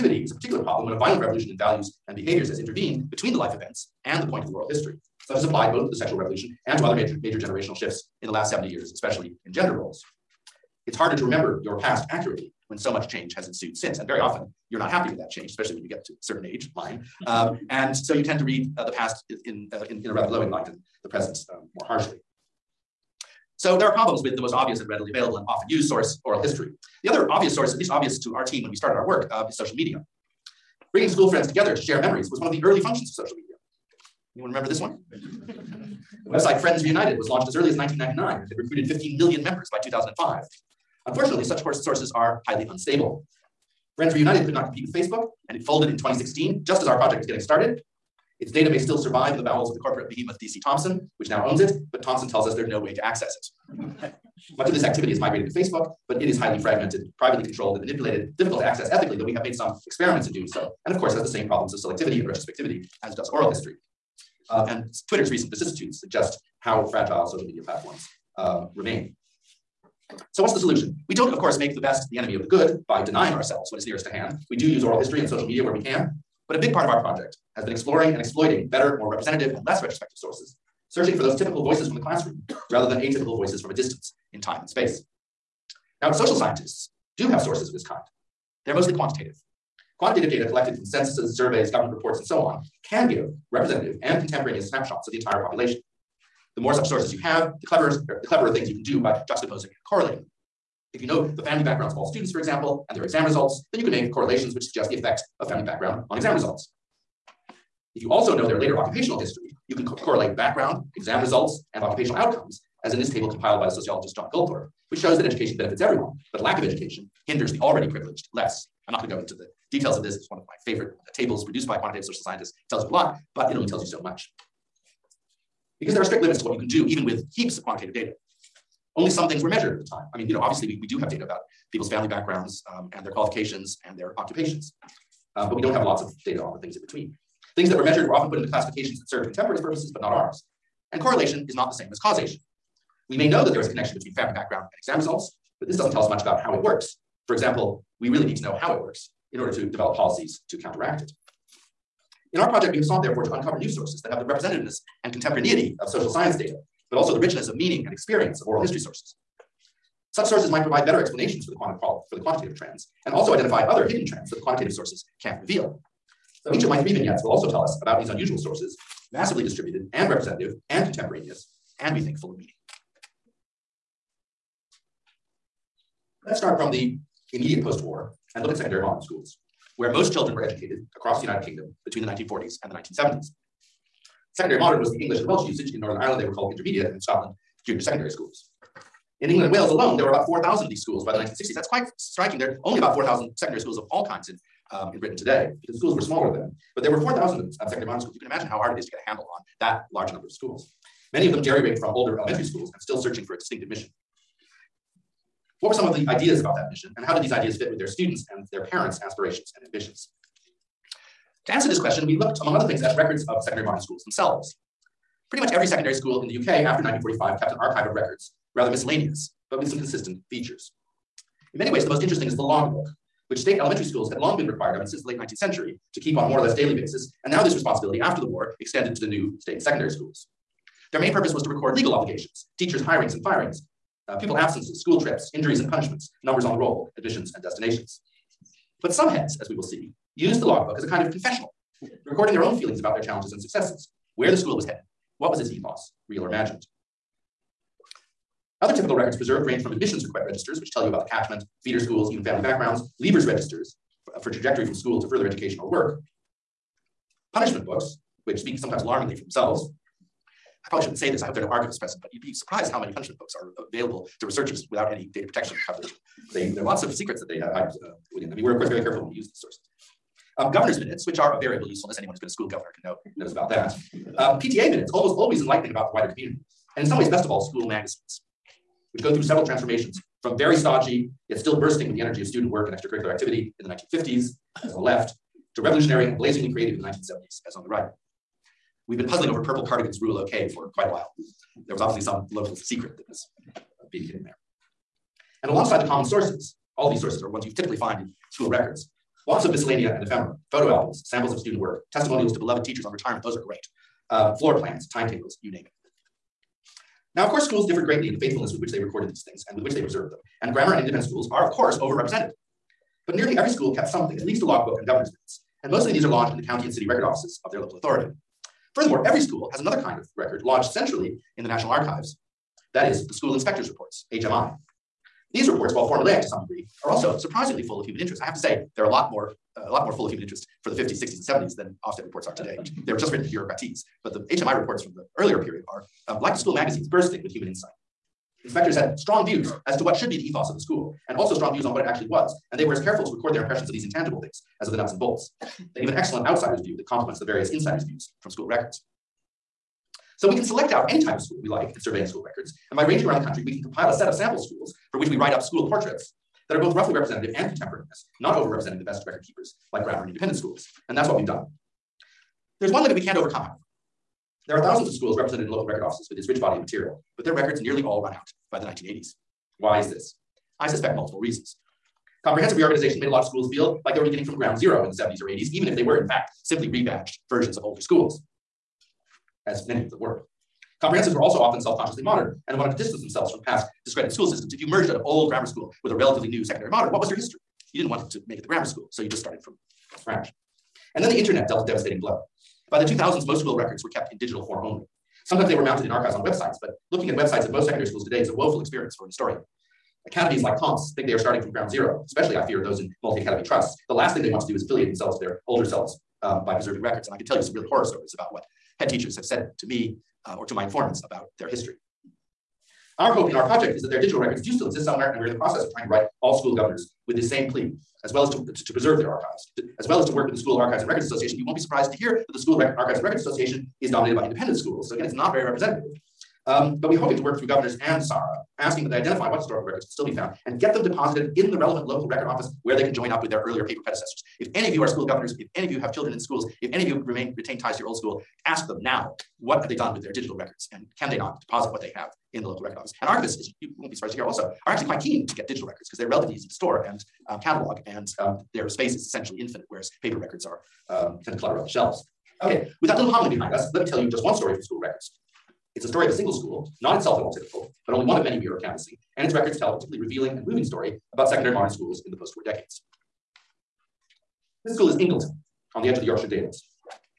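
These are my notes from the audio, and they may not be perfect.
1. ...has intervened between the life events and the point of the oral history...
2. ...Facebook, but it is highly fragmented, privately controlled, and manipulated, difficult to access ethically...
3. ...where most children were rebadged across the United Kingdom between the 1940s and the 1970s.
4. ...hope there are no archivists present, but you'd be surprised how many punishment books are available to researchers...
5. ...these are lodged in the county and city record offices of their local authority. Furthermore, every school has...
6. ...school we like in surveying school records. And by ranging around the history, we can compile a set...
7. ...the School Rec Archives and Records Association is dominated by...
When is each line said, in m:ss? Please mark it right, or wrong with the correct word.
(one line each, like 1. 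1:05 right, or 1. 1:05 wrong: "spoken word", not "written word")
1. 0:02 right
2. 0:55 right
3. 2:59 wrong: "educated", not "rebadged"
4. 4:21 right
5. 5:15 right
6. 5:51 wrong: "country", not "history"
7. 7:02 right.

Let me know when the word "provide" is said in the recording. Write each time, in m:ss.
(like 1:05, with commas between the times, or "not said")
2:40.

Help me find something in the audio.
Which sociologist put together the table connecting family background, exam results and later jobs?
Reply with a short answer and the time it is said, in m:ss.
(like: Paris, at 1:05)
John Goldthorpe, at 1:54.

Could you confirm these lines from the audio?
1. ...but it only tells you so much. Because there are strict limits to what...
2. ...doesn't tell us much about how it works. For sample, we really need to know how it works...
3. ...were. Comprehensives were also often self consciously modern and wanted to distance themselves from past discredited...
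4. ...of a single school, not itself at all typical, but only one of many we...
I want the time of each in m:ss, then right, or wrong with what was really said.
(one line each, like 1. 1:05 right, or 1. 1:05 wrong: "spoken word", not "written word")
1. 2:03 right
2. 2:25 wrong: "example", not "sample"
3. 6:19 right
4. 7:36 right.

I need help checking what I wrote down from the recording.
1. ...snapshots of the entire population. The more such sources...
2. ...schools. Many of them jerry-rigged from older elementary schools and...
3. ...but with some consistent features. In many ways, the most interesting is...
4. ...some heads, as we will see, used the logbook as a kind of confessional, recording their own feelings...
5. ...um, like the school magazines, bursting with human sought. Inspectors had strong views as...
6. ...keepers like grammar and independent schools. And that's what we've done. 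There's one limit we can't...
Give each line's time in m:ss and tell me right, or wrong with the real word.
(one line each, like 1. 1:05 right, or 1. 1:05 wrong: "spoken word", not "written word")
1. 1:34 right
2. 3:20 right
3. 3:39 right
4. 3:58 right
5. 5:36 wrong: "insight", not "sought"
6. 5:59 right.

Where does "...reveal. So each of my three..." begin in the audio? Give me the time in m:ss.
2:45.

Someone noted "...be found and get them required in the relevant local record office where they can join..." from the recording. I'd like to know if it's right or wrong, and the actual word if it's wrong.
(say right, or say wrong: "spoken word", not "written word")
wrong: "deposited", not "required".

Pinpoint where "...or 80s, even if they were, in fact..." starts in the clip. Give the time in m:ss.
6:15.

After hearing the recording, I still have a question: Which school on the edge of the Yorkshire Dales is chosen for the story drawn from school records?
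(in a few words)
Ingleton.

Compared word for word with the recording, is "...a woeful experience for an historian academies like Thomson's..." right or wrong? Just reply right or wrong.
wrong.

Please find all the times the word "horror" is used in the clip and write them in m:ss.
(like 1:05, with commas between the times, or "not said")
6:47.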